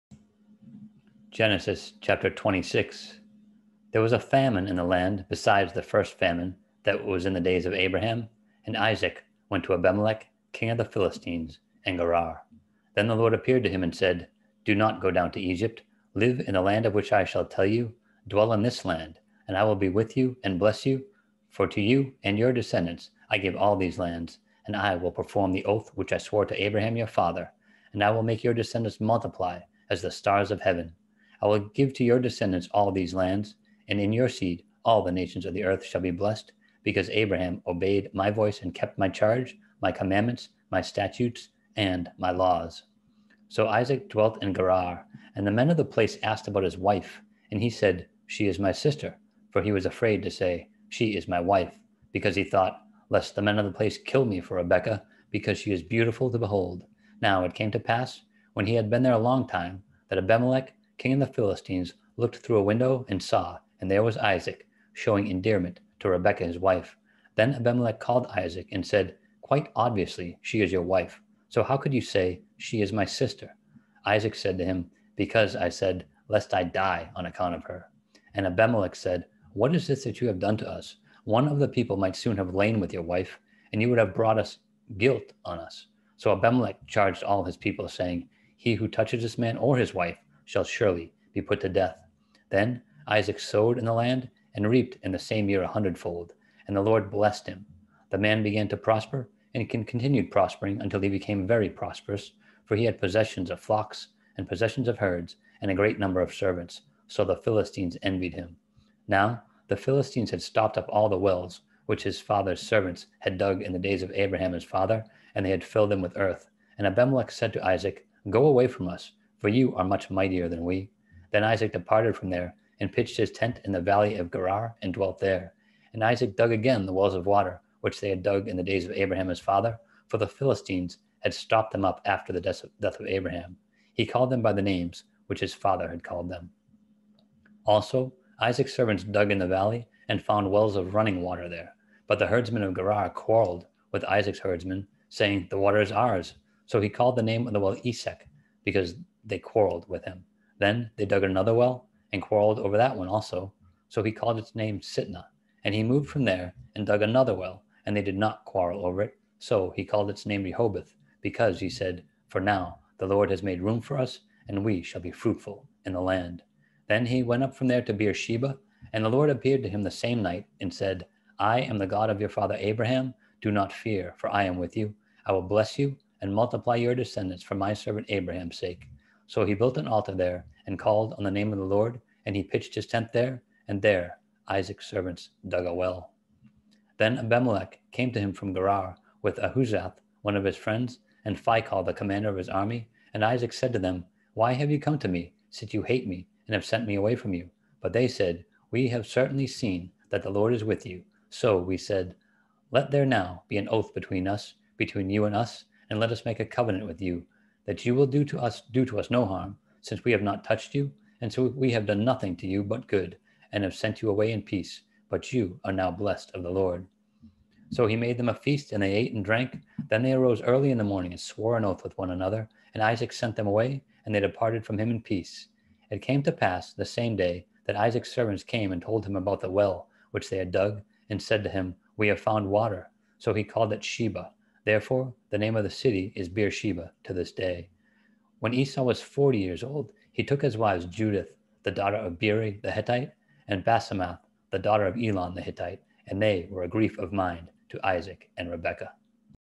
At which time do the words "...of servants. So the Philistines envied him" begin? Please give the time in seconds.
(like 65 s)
106 s.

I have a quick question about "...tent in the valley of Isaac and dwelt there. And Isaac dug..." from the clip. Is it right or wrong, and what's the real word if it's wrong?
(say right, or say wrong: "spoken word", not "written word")
wrong: "Gerar", not "Isaac".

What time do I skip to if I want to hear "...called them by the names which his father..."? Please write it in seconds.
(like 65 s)
134 s.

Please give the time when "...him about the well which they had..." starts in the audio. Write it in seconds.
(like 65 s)
229 s.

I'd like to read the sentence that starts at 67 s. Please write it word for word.
Then Abimelech called Isaac and said, Quite obviously, she is your wife.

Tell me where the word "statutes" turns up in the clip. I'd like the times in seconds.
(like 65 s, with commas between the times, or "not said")
40 s.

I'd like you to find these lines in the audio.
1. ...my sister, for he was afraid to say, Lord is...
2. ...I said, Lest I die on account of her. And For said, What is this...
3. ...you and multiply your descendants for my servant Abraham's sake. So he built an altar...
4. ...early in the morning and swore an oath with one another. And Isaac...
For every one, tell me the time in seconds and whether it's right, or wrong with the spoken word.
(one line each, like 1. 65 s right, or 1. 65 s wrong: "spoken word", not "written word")
1. 48 s wrong: "She", not "Lord"
2. 75 s wrong: "Abimelech", not "For"
3. 175 s right
4. 220 s right.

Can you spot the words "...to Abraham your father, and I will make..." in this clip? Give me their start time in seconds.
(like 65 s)
26 s.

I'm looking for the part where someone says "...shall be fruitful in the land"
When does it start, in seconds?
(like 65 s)
164 s.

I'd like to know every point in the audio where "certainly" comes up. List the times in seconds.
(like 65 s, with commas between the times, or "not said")
199 s.